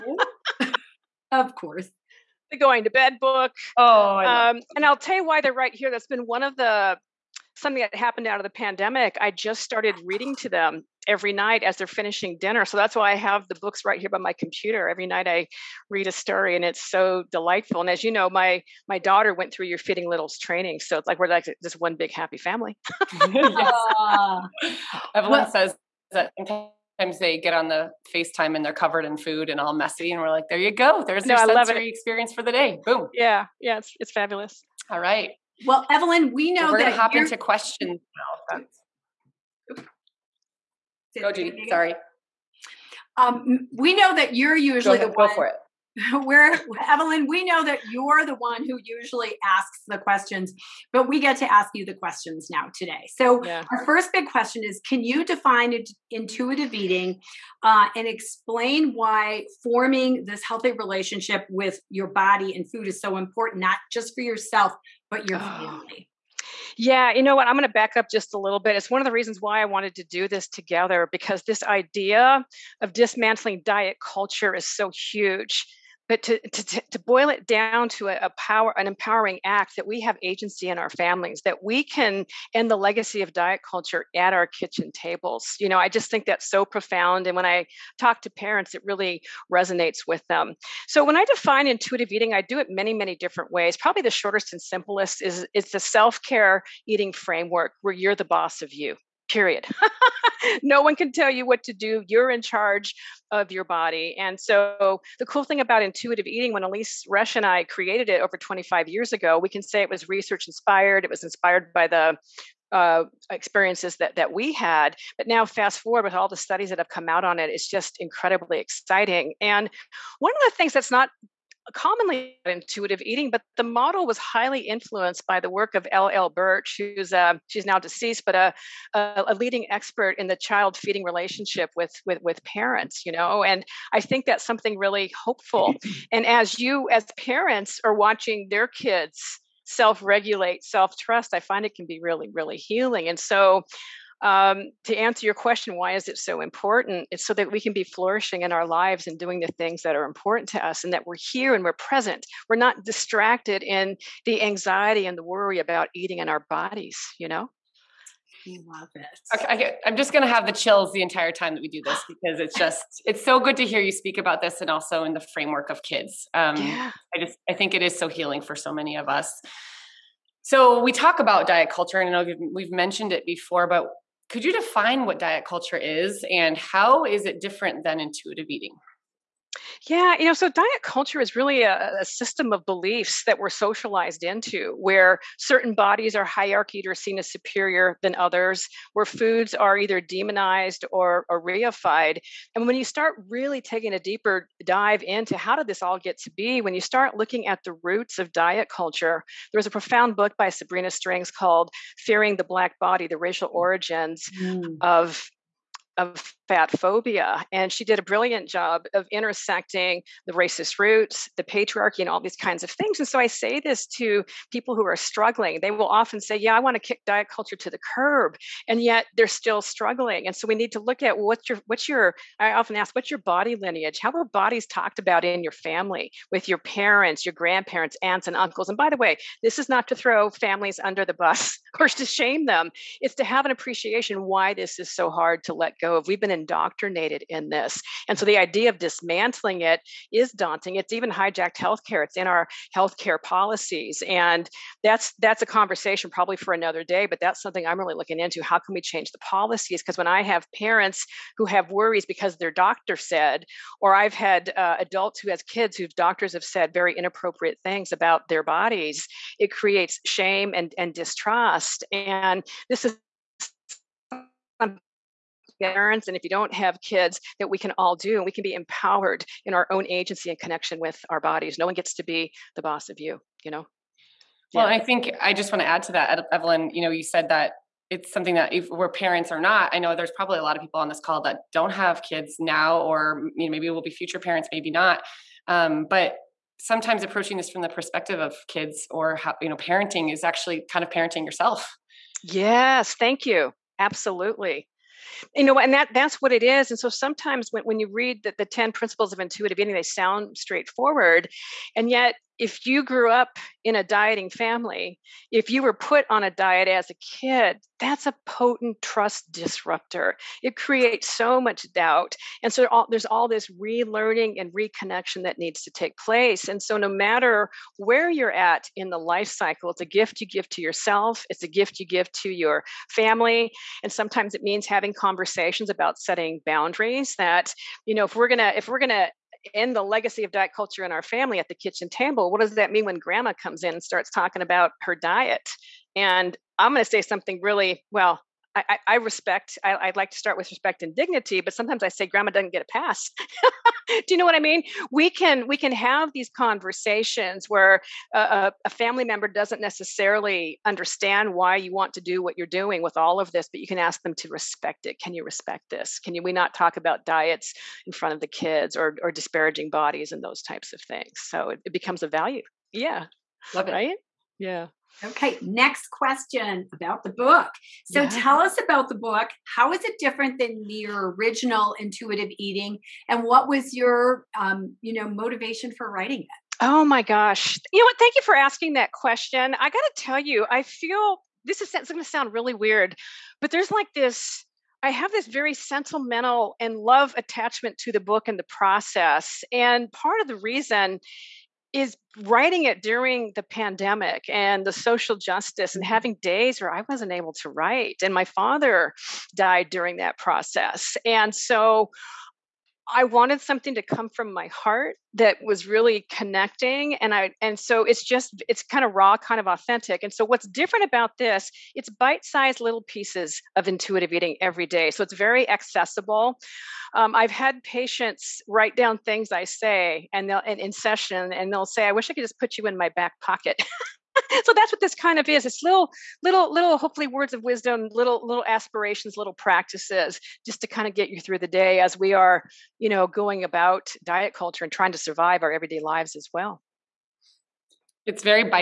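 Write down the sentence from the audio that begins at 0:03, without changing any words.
Oh, um, and I'll tell you why they're right here.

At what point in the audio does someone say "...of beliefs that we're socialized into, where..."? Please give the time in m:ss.
3:02.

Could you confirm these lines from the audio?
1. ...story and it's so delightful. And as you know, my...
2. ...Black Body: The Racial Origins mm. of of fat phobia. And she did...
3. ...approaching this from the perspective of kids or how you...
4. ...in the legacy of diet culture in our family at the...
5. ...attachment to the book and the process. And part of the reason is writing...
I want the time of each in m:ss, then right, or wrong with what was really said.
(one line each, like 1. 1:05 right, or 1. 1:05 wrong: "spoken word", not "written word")
1. 0:16 right
2. 3:22 right
3. 4:47 right
4. 5:29 right
5. 6:27 right.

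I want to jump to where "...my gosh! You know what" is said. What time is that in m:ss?
6:16.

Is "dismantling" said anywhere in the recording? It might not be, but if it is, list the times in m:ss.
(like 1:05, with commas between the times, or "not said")
1:12, 3:58.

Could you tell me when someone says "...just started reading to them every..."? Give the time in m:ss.
0:09.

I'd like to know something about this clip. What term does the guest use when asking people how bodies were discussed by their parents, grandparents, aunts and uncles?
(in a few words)
body lineage.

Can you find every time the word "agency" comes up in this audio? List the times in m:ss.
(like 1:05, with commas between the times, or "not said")
1:20, 4:29.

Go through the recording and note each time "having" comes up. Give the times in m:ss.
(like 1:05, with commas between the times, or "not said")
5:24, 6:35.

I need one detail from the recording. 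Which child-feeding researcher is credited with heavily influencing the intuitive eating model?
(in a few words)
L. Birch.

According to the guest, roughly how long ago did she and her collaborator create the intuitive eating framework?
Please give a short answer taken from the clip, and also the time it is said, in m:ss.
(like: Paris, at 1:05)
over 25 years ago, at 1:48.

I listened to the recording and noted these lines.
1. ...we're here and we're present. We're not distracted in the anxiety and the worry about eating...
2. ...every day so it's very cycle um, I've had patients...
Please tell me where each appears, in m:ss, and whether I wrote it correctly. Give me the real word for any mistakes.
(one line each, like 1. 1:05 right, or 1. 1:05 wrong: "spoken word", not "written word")
1. 2:31 right
2. 6:54 wrong: "accessible", not "cycle".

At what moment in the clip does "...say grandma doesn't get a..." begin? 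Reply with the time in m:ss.
5:41.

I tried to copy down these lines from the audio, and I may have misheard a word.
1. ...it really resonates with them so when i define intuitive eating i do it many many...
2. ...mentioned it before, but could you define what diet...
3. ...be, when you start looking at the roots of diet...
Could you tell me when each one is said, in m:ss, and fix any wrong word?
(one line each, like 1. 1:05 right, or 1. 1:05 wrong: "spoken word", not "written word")
1. 1:28 right
2. 2:52 right
3. 3:16 right.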